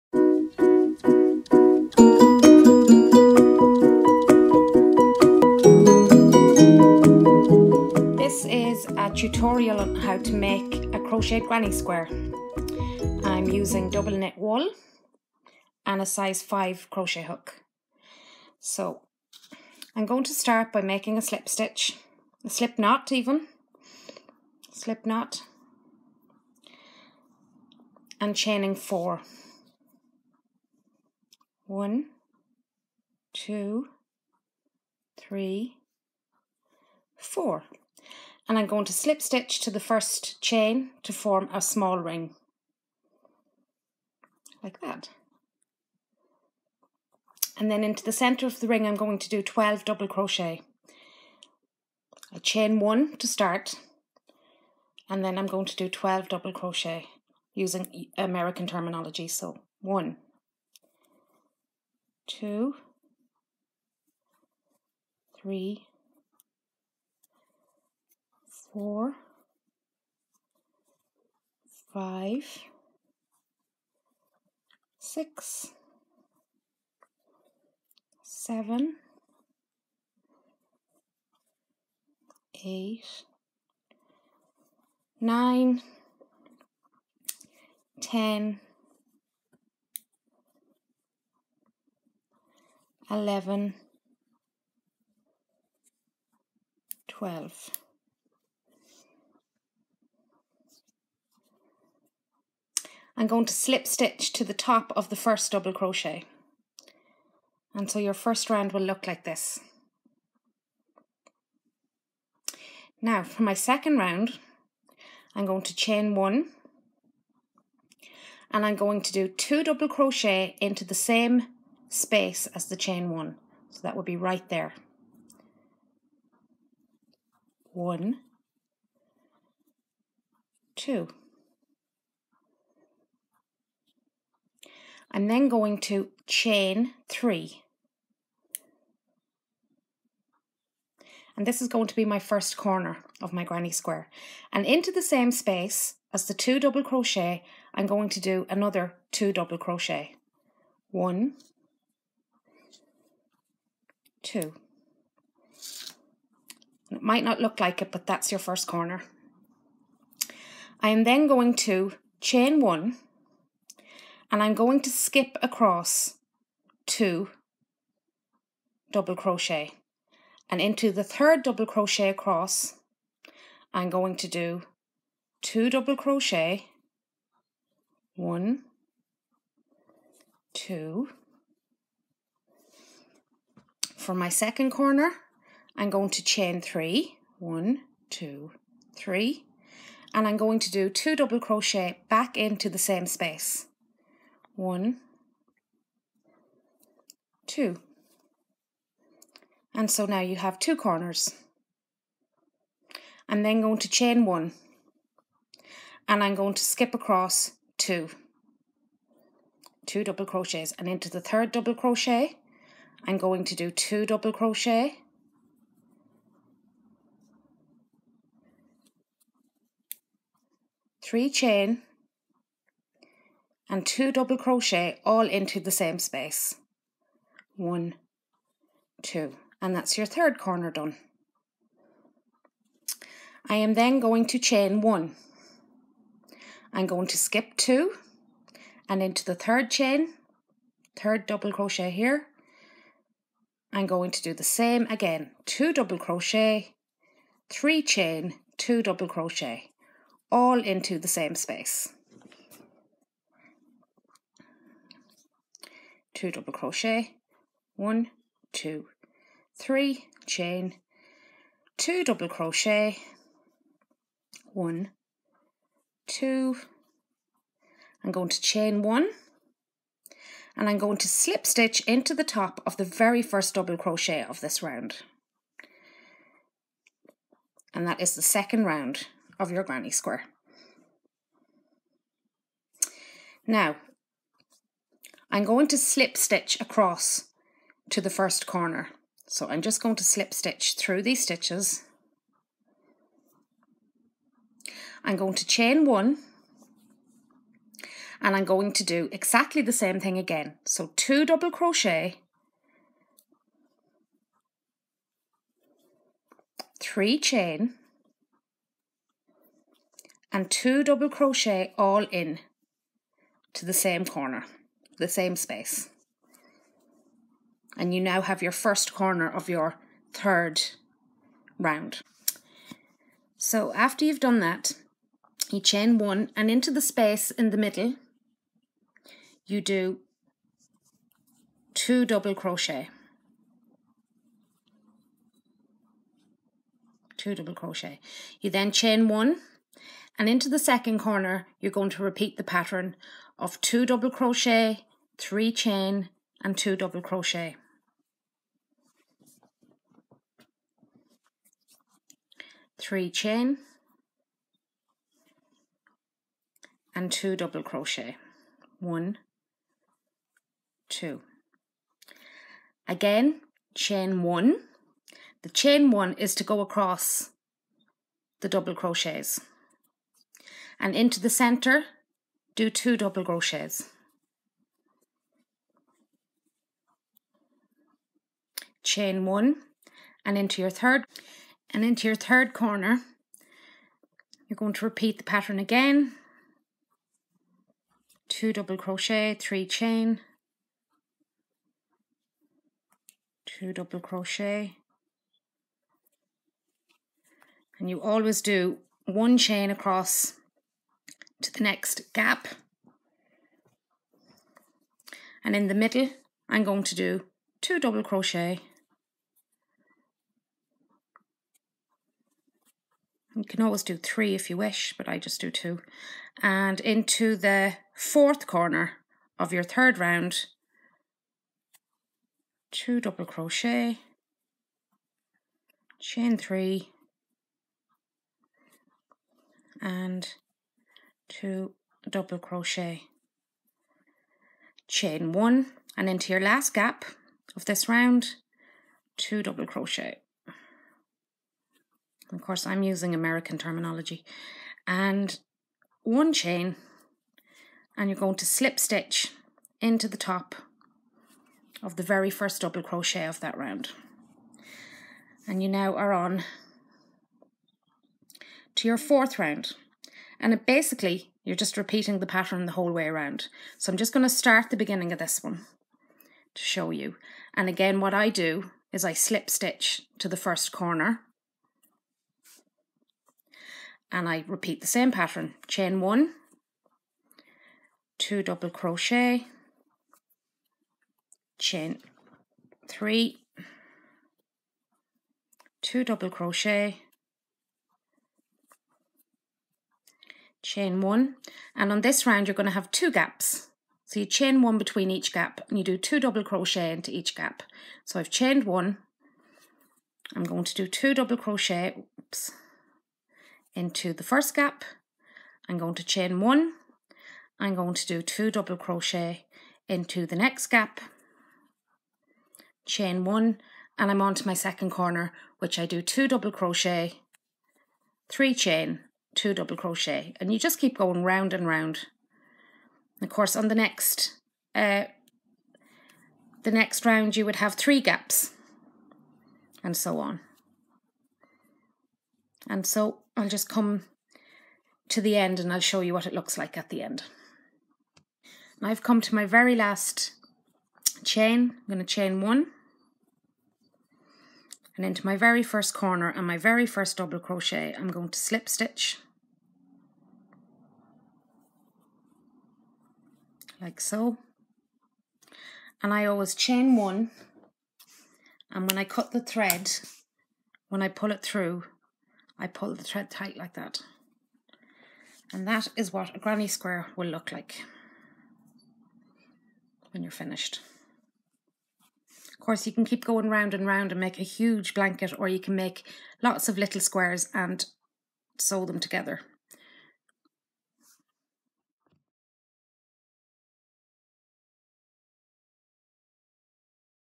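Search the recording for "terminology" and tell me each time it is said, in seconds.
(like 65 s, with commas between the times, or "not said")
58 s, 443 s.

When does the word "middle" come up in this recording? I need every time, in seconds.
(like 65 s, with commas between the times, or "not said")
327 s, 405 s.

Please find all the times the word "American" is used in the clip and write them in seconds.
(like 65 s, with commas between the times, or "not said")
58 s, 443 s.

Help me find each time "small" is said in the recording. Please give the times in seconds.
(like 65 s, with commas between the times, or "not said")
41 s.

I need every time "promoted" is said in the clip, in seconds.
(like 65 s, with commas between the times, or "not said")
not said.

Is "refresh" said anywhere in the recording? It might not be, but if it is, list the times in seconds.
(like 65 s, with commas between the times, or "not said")
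not said.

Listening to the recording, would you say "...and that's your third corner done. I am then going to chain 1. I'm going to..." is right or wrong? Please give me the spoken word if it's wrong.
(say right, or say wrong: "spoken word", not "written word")
right.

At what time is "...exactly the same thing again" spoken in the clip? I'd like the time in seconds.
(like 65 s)
299 s.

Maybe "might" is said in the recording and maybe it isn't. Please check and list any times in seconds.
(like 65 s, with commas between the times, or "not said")
157 s.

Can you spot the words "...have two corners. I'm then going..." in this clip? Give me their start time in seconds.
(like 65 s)
200 s.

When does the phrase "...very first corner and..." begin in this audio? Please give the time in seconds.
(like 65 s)
545 s.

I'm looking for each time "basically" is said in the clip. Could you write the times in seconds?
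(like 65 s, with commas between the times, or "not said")
460 s.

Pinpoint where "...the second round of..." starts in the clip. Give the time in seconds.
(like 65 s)
278 s.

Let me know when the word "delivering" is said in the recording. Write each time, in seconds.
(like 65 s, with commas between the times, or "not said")
not said.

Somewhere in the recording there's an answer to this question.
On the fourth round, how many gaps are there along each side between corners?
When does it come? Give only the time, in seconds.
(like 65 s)
492 s.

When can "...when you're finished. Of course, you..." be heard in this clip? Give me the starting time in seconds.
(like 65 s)
570 s.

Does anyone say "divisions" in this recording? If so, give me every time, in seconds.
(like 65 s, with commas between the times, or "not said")
not said.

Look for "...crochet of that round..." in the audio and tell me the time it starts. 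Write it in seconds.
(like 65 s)
452 s.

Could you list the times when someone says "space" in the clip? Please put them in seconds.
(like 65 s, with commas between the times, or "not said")
121 s, 145 s, 193 s, 225 s, 251 s, 315 s, 326 s.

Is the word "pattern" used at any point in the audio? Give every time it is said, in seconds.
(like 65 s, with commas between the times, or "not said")
342 s, 385 s, 462 s, 475 s.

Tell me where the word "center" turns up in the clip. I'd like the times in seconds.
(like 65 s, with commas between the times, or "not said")
48 s, 371 s.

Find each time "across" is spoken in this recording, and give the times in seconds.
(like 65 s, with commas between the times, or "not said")
165 s, 172 s, 206 s, 286 s, 366 s, 399 s.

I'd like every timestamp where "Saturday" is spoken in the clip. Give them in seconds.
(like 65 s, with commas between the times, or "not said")
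not said.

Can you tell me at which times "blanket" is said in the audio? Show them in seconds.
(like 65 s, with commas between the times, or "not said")
574 s.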